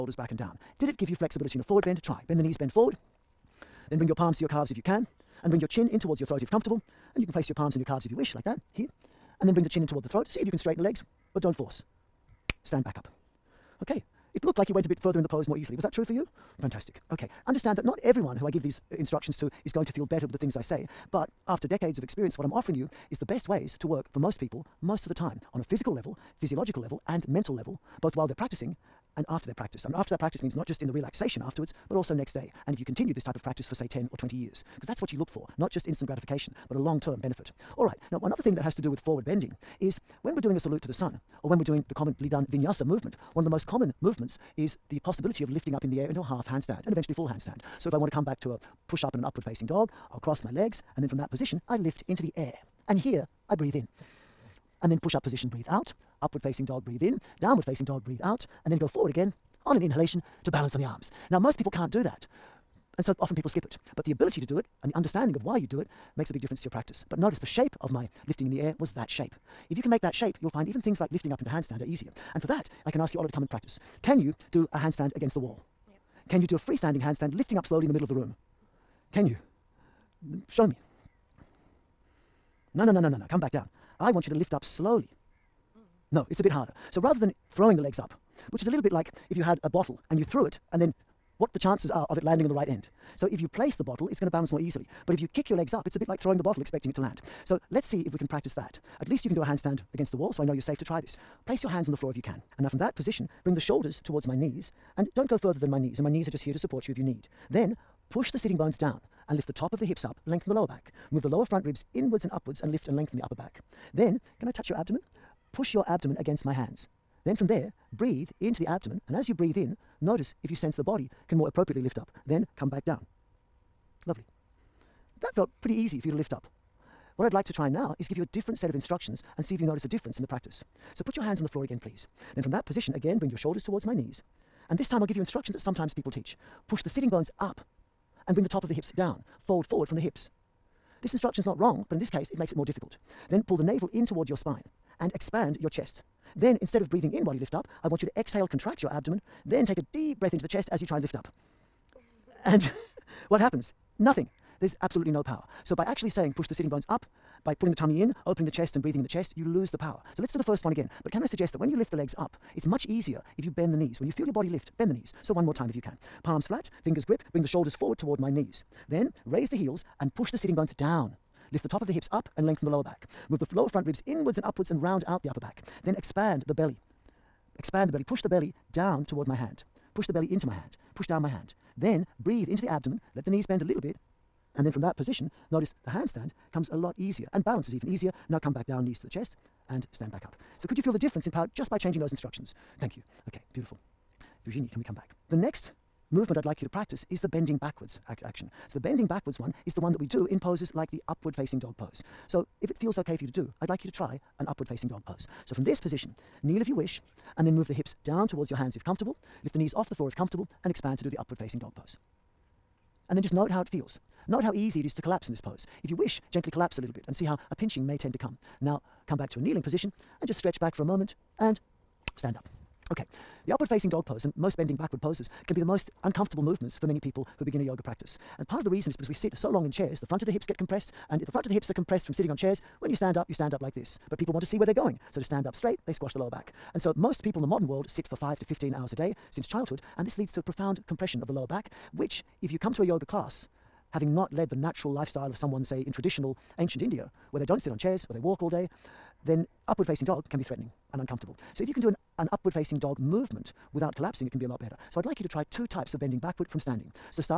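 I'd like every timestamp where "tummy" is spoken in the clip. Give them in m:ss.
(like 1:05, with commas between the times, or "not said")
2:37.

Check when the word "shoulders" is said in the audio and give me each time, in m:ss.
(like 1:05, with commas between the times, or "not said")
1:43, 2:13, 2:47.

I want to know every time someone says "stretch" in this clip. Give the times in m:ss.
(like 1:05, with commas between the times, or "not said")
3:40.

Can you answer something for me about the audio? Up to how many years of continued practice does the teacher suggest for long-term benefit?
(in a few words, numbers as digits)
20.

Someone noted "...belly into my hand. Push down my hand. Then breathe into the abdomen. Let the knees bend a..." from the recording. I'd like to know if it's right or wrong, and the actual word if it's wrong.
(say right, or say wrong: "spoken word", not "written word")
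right.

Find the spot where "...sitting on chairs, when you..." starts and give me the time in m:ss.
3:52.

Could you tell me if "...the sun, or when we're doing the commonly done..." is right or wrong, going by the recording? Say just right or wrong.
right.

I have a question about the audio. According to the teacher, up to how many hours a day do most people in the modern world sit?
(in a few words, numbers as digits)
15.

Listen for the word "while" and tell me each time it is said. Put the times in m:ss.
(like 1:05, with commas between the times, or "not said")
0:28, 2:27.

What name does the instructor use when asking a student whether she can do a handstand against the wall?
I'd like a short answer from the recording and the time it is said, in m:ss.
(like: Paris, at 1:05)
Ola, at 1:13.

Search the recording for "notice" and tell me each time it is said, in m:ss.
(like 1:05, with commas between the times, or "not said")
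1:07, 2:00, 2:09, 3:05.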